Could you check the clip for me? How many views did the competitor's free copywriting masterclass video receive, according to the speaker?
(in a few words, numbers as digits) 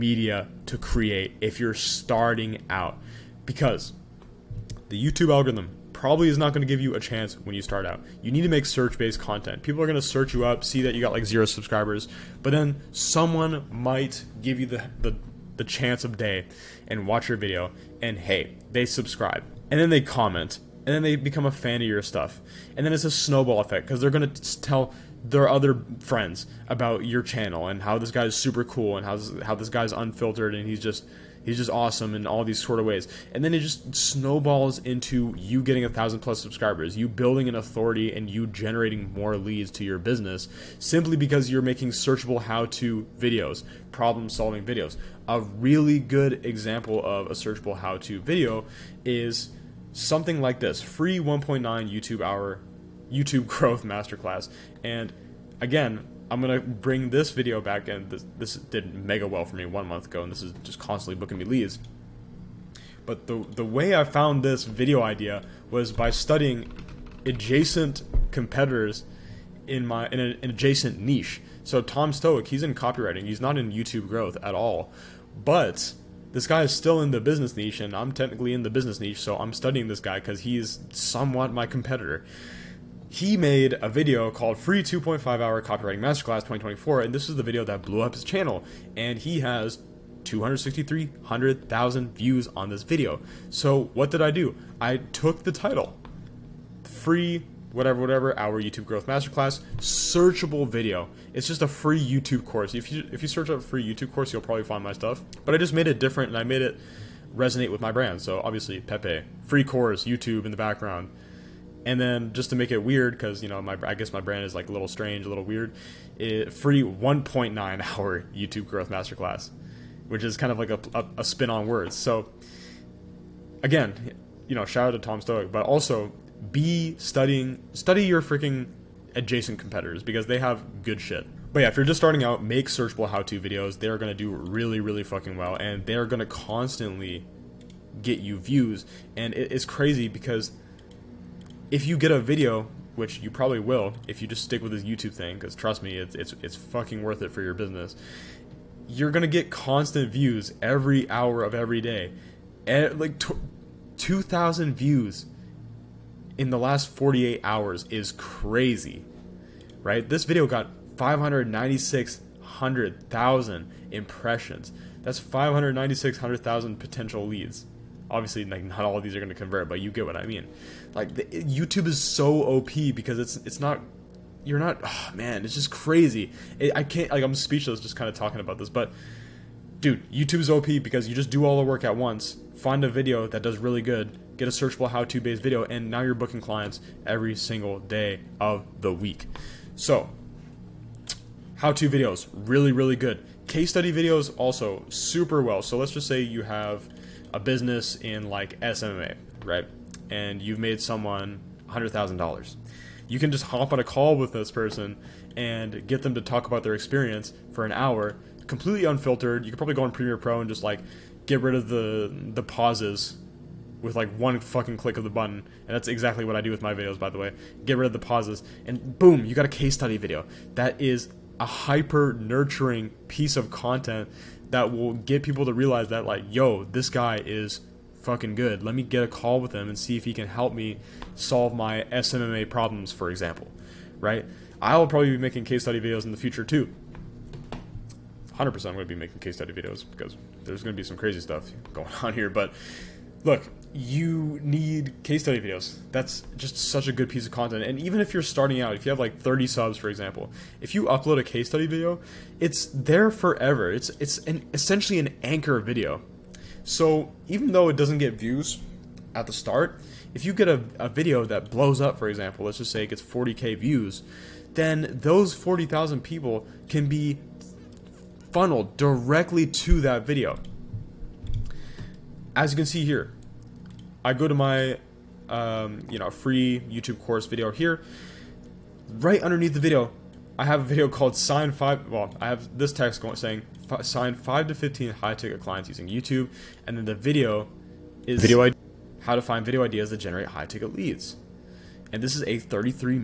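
263,000.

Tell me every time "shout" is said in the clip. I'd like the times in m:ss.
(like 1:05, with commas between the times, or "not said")
2:04.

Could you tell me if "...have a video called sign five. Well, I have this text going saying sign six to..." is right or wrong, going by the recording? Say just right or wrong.
wrong.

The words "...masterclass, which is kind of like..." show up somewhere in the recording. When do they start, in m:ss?
1:58.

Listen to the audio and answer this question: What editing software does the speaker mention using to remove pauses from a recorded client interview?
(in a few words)
Premiere Pro.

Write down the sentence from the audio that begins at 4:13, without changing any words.
It's it's an, essentially an anchor video.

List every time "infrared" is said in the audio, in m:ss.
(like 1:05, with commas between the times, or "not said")
not said.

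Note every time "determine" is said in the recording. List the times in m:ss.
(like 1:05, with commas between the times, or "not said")
not said.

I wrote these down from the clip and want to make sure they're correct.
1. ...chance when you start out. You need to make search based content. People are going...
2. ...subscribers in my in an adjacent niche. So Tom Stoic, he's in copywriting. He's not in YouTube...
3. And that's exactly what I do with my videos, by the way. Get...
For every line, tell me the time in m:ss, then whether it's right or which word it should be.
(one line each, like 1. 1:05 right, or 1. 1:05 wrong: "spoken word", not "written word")
1. 0:07 right
2. 1:08 wrong: "competitors", not "subscribers"
3. 3:35 right.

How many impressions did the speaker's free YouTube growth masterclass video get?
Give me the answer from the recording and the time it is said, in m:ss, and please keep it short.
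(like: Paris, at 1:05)
596,000, at 2:40.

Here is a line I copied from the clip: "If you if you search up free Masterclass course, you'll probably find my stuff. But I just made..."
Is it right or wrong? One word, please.
wrong.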